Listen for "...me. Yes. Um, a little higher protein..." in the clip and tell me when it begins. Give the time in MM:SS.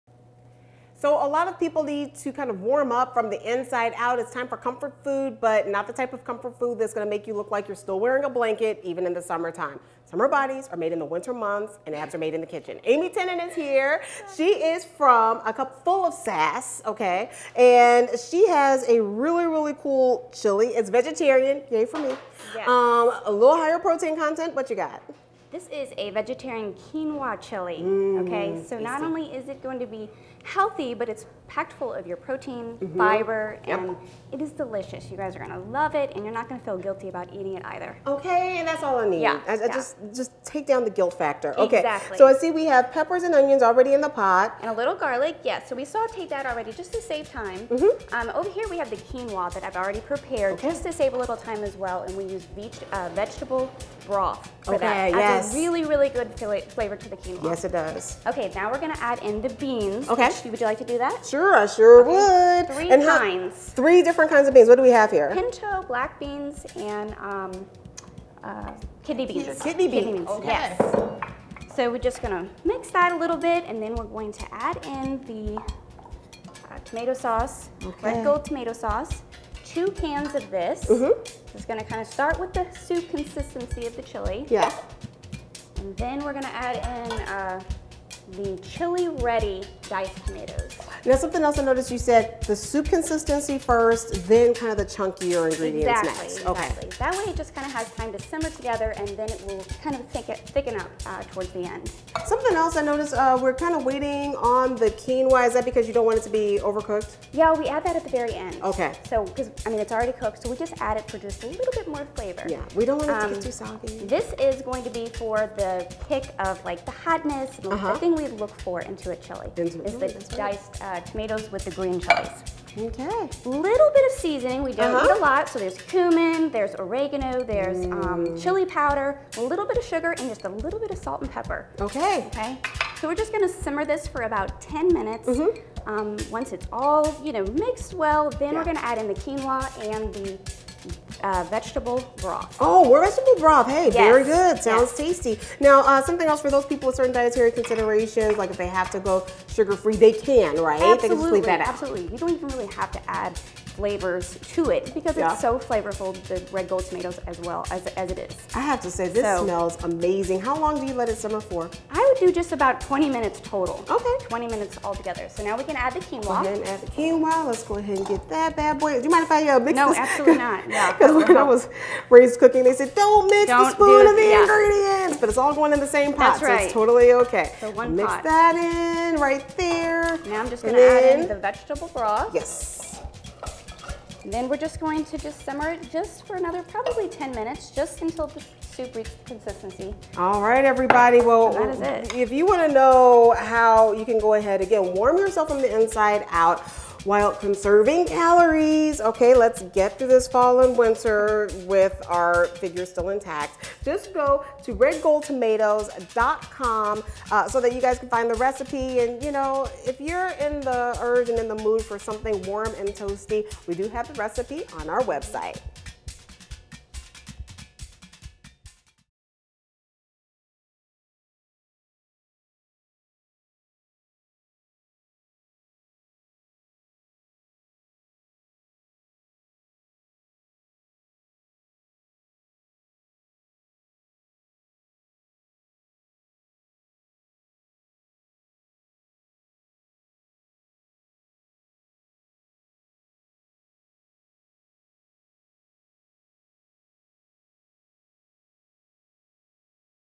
00:21.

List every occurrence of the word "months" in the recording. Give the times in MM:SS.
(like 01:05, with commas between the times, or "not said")
00:11.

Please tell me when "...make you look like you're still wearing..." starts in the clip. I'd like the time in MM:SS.
00:07.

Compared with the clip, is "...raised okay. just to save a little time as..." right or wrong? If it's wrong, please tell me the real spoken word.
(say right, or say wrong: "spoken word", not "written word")
wrong: "prepared", not "raised".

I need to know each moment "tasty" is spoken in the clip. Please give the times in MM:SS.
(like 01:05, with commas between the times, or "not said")
00:28, 02:25.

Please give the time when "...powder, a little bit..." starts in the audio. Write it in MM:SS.
02:08.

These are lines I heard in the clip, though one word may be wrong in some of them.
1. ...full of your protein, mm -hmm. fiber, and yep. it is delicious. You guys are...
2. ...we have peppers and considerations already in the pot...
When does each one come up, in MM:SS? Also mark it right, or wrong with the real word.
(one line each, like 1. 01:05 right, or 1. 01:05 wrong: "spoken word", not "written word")
1. 00:31 right
2. 00:42 wrong: "onions", not "considerations".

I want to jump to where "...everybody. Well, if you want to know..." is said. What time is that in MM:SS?
03:10.